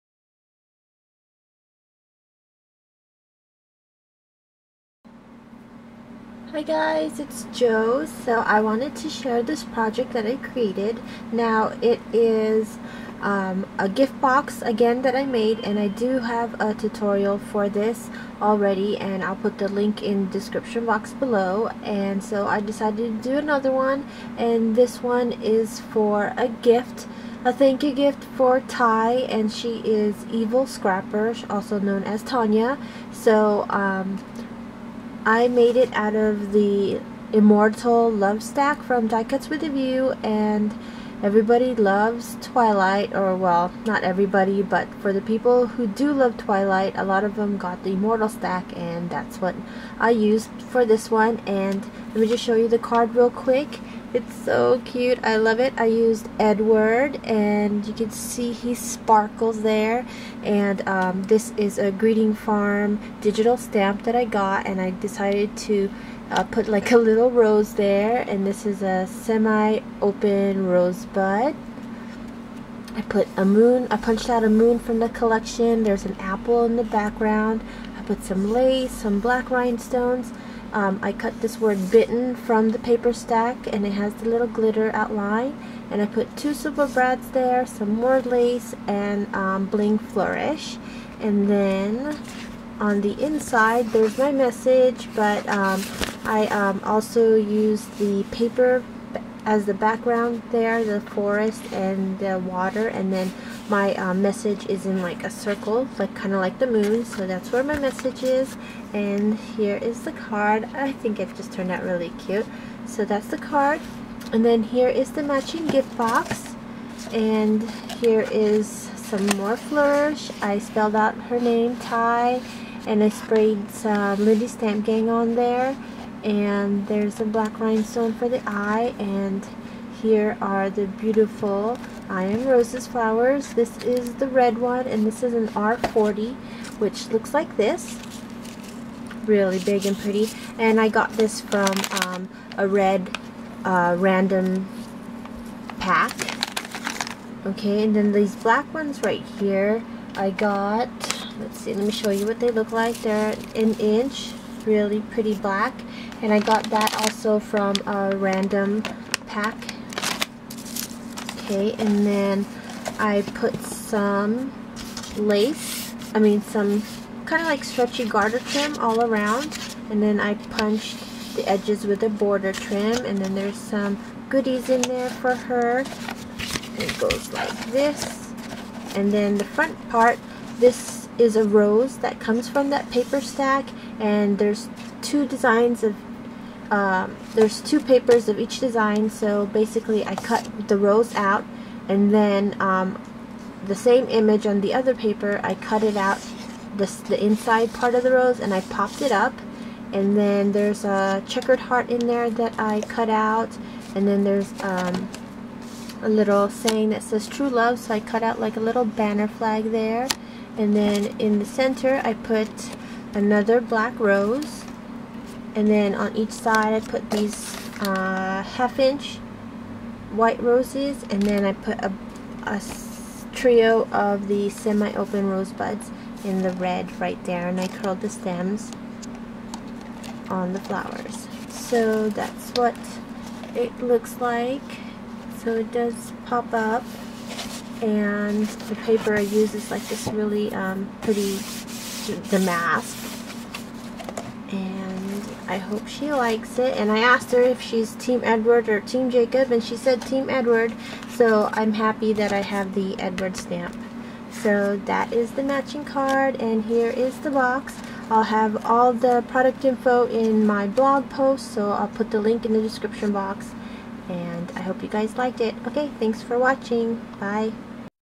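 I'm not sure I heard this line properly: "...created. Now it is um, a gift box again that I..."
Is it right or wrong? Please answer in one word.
right.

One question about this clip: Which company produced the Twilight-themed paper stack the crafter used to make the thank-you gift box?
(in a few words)
Die Cuts With a View.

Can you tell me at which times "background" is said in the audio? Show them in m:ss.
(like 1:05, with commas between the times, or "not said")
1:16, 1:39.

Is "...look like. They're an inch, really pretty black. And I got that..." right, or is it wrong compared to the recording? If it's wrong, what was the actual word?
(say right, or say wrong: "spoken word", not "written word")
right.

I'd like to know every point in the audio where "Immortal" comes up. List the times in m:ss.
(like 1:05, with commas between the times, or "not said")
0:37, 0:47.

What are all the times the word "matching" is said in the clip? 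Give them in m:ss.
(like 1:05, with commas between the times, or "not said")
1:55, 4:15.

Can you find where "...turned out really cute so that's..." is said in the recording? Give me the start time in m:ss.
1:51.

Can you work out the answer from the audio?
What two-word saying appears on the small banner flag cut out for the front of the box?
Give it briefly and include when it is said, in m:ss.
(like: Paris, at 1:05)
true love, at 3:27.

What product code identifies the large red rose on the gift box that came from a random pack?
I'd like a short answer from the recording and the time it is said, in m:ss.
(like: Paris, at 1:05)
R40, at 2:15.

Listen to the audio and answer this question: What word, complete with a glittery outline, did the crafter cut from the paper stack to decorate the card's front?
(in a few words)
bitten.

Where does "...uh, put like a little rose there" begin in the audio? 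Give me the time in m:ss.
1:06.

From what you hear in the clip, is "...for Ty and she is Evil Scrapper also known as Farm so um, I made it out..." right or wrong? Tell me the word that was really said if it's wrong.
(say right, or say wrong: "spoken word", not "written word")
wrong: "Tanya", not "Farm".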